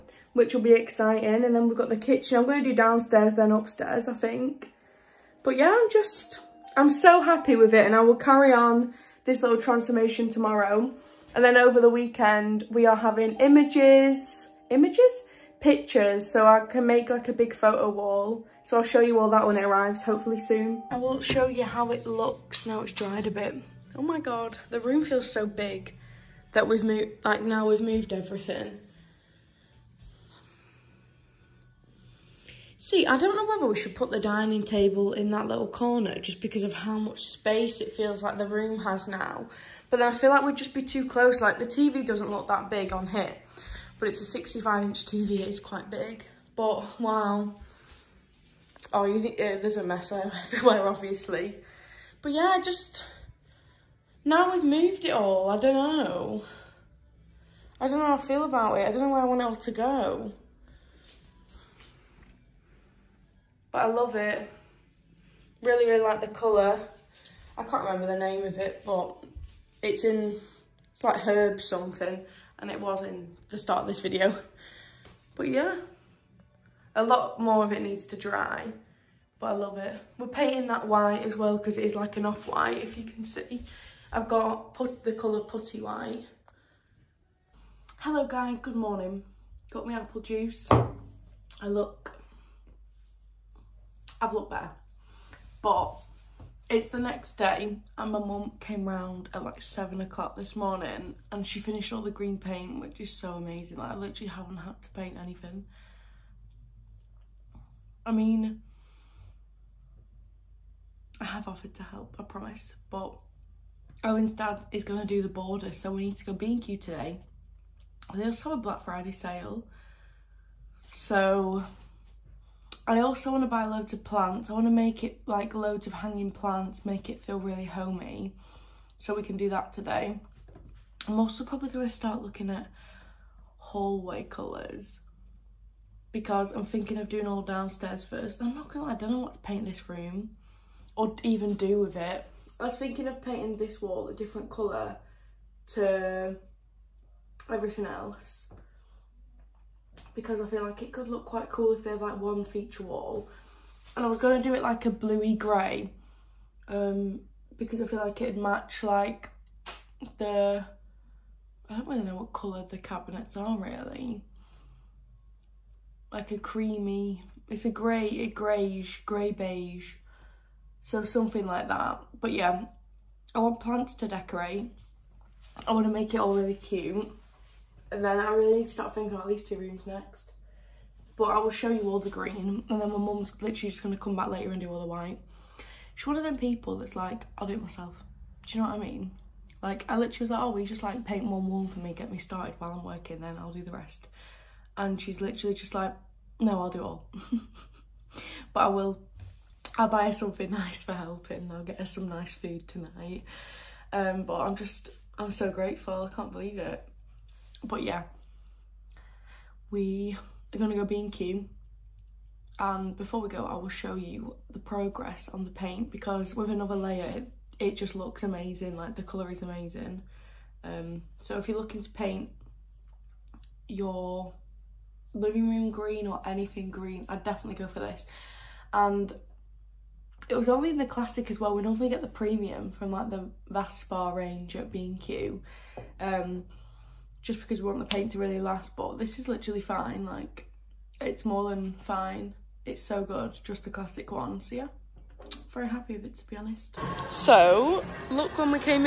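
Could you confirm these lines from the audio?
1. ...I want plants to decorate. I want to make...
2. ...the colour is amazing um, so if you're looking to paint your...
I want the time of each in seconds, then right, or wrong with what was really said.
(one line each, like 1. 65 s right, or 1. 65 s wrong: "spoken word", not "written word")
1. 173 s right
2. 218 s right.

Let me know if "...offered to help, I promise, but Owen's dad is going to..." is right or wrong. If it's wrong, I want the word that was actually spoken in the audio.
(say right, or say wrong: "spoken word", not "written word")
right.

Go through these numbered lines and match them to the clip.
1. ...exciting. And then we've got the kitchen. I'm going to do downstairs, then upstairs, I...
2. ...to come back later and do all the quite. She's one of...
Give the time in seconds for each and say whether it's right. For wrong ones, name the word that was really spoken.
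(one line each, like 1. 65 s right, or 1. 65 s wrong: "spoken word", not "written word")
1. 0 s right
2. 183 s wrong: "white", not "quite".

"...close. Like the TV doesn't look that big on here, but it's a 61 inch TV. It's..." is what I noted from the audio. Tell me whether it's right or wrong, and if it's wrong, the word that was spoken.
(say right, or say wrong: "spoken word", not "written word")
wrong: "65", not "61".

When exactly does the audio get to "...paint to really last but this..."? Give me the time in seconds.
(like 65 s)
237 s.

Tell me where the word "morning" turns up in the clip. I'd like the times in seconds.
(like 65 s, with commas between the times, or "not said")
88 s, 100 s.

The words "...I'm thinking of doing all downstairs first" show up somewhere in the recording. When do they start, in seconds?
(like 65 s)
136 s.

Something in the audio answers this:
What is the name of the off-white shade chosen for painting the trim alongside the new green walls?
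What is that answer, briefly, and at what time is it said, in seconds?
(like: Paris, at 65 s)
putty white, at 85 s.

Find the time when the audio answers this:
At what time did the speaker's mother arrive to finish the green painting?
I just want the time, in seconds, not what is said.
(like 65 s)
99 s.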